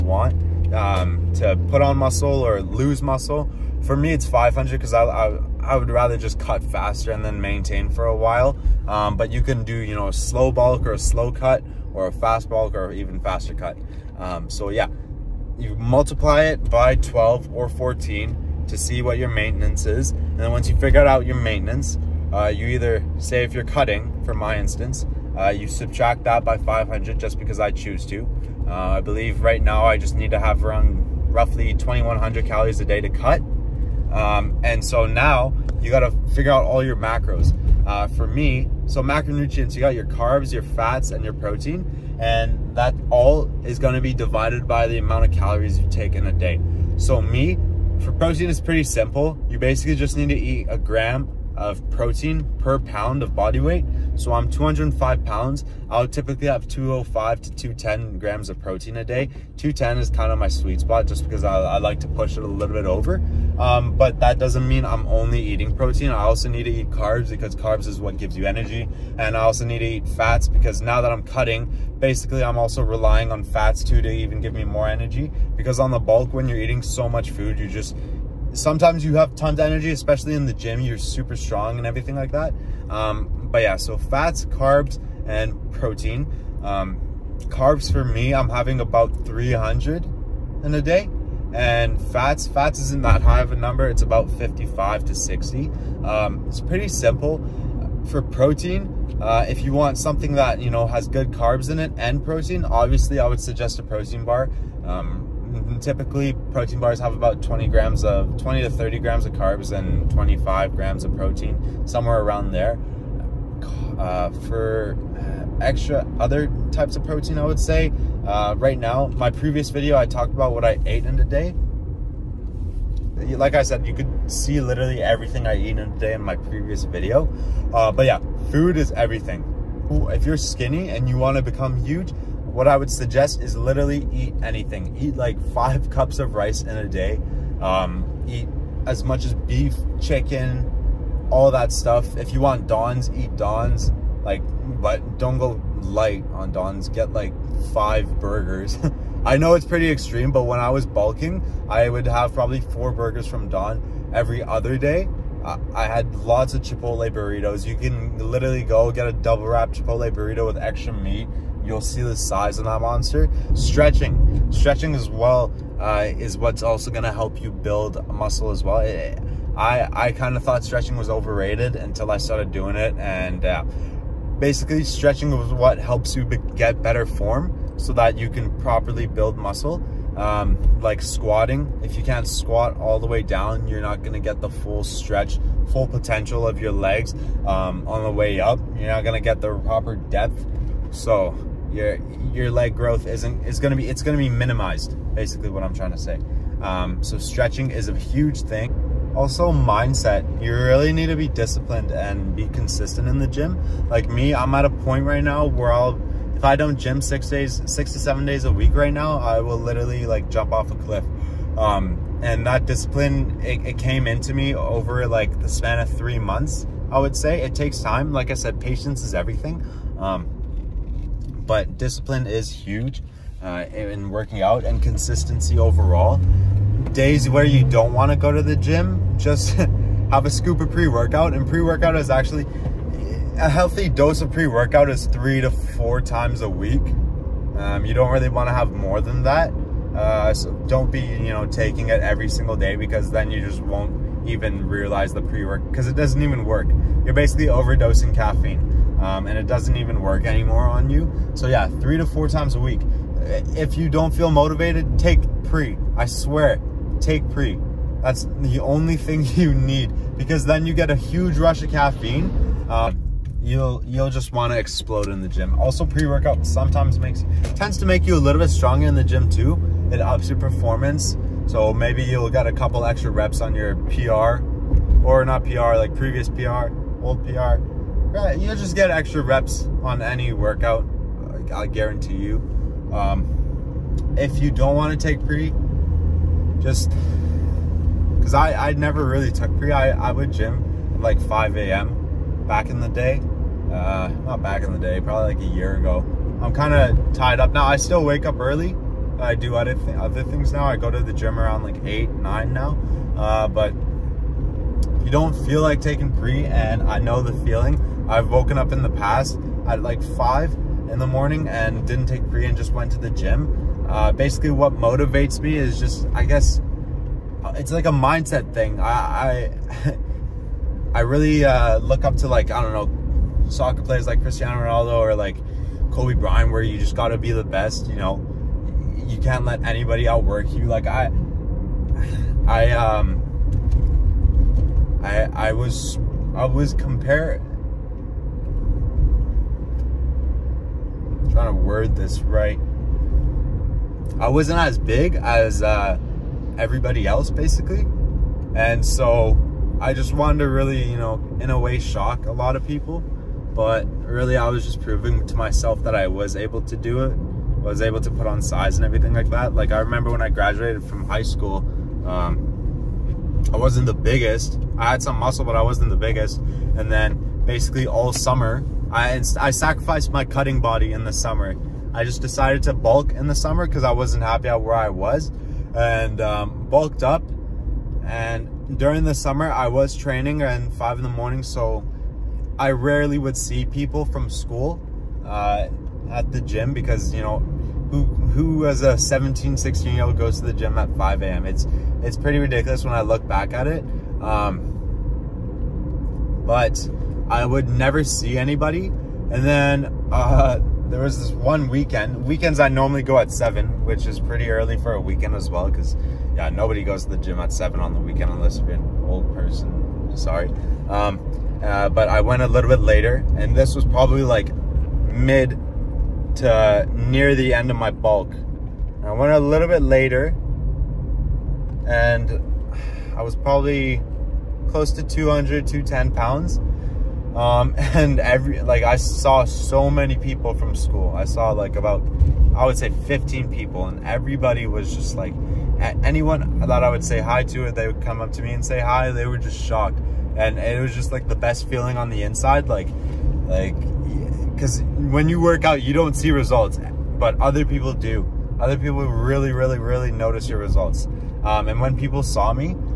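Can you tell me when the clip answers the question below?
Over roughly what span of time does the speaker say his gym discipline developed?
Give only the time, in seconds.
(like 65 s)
215 s.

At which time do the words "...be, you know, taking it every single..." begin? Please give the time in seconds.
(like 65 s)
240 s.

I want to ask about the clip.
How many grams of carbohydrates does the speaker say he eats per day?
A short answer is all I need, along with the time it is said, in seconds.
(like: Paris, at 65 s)
300, at 89 s.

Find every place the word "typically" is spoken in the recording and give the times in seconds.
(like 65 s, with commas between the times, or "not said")
56 s, 105 s.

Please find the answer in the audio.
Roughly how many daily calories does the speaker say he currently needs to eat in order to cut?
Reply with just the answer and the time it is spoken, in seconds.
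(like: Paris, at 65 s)
2,100, at 31 s.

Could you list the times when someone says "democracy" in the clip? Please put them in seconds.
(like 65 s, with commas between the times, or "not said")
not said.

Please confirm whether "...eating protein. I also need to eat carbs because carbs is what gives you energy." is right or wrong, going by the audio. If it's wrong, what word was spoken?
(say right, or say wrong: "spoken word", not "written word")
right.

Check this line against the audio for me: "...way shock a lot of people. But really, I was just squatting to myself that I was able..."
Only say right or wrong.
wrong.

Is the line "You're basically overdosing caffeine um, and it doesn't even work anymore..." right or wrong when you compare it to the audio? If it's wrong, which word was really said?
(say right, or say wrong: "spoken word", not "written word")
right.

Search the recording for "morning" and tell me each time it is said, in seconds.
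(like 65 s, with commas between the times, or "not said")
311 s, 381 s.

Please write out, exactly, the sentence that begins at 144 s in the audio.
Like, but don't go light on dons.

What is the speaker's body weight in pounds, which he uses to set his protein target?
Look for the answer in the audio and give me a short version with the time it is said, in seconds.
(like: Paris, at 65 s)
205, at 54 s.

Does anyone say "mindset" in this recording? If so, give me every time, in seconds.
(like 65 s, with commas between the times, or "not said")
199 s, 317 s.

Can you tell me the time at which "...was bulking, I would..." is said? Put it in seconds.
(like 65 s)
150 s.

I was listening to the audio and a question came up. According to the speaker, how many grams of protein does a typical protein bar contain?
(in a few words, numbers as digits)
25.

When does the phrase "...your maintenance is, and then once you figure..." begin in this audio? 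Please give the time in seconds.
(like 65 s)
19 s.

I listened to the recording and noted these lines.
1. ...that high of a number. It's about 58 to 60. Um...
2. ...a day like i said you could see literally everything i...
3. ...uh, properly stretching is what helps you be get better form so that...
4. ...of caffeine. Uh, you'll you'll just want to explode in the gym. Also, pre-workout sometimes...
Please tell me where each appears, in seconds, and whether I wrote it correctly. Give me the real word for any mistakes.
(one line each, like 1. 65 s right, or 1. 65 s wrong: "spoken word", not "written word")
1. 93 s wrong: "55", not "58"
2. 121 s right
3. 173 s wrong: "basically", not "properly"
4. 261 s right.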